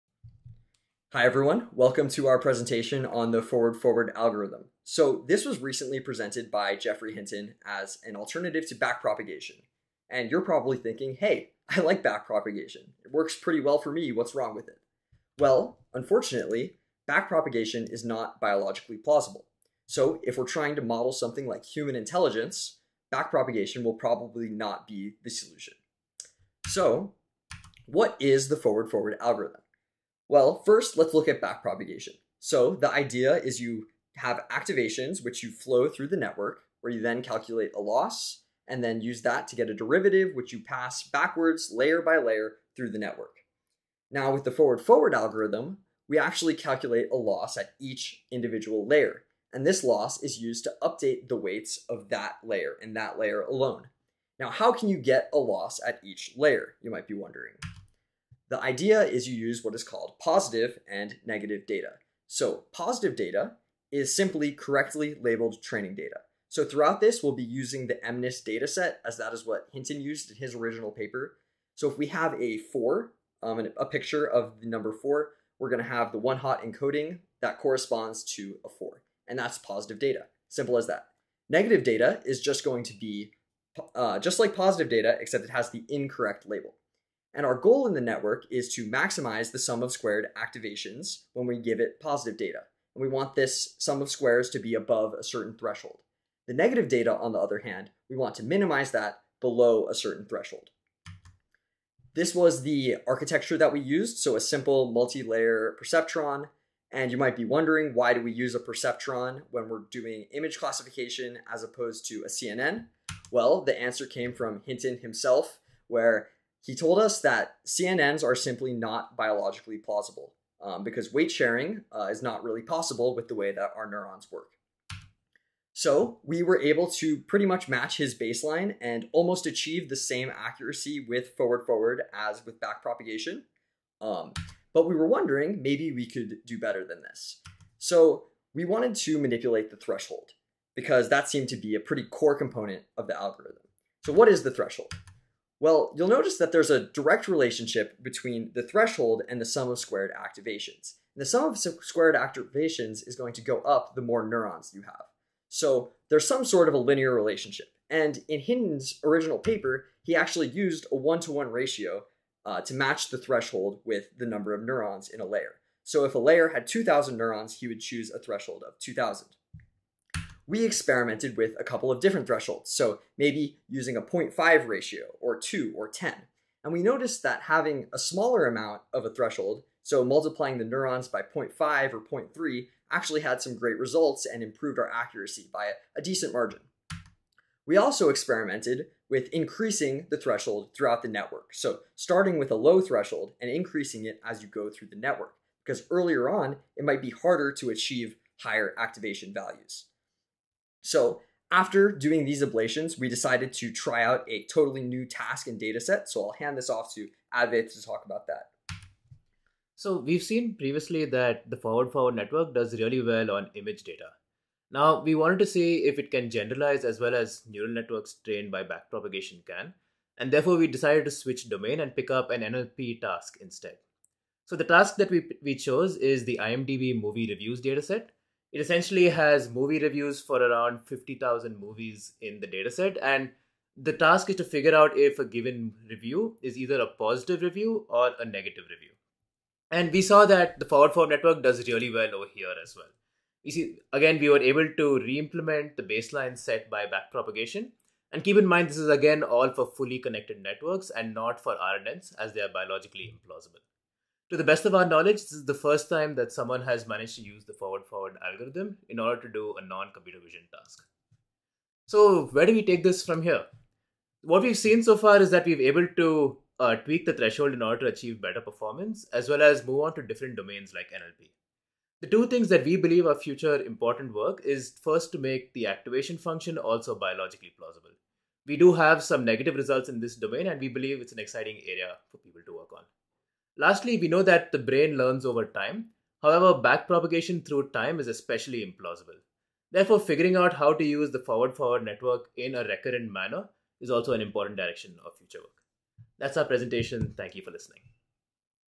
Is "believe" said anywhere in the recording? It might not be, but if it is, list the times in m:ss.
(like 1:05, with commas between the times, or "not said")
4:32, 4:40.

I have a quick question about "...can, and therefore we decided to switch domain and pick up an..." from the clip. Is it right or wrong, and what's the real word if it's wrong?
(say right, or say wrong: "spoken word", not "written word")
right.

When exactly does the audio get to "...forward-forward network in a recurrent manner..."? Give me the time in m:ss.
4:51.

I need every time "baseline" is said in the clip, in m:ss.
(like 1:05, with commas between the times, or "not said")
2:08, 4:05.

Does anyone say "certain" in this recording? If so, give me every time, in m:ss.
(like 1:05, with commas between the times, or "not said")
1:35, 1:39.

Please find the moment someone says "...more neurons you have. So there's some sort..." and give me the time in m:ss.
2:34.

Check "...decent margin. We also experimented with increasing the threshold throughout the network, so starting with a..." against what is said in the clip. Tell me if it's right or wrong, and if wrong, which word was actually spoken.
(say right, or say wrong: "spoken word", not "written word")
right.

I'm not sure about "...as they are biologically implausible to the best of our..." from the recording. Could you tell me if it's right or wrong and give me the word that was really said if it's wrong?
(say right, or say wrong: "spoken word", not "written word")
right.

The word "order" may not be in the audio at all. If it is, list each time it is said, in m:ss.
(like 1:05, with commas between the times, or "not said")
4:18, 4:27.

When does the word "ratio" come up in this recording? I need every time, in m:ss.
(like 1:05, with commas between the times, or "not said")
2:41, 2:54.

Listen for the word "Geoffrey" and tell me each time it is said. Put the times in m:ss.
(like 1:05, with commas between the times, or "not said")
0:06.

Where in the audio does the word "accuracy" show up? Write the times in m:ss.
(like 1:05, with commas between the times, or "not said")
2:10, 3:04.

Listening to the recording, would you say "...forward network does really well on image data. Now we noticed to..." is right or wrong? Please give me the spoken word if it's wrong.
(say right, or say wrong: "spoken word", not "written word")
wrong: "wanted", not "noticed".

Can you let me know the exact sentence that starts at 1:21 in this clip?
Negative data is just going to be uh, just like positive data, except it has the incorrect label.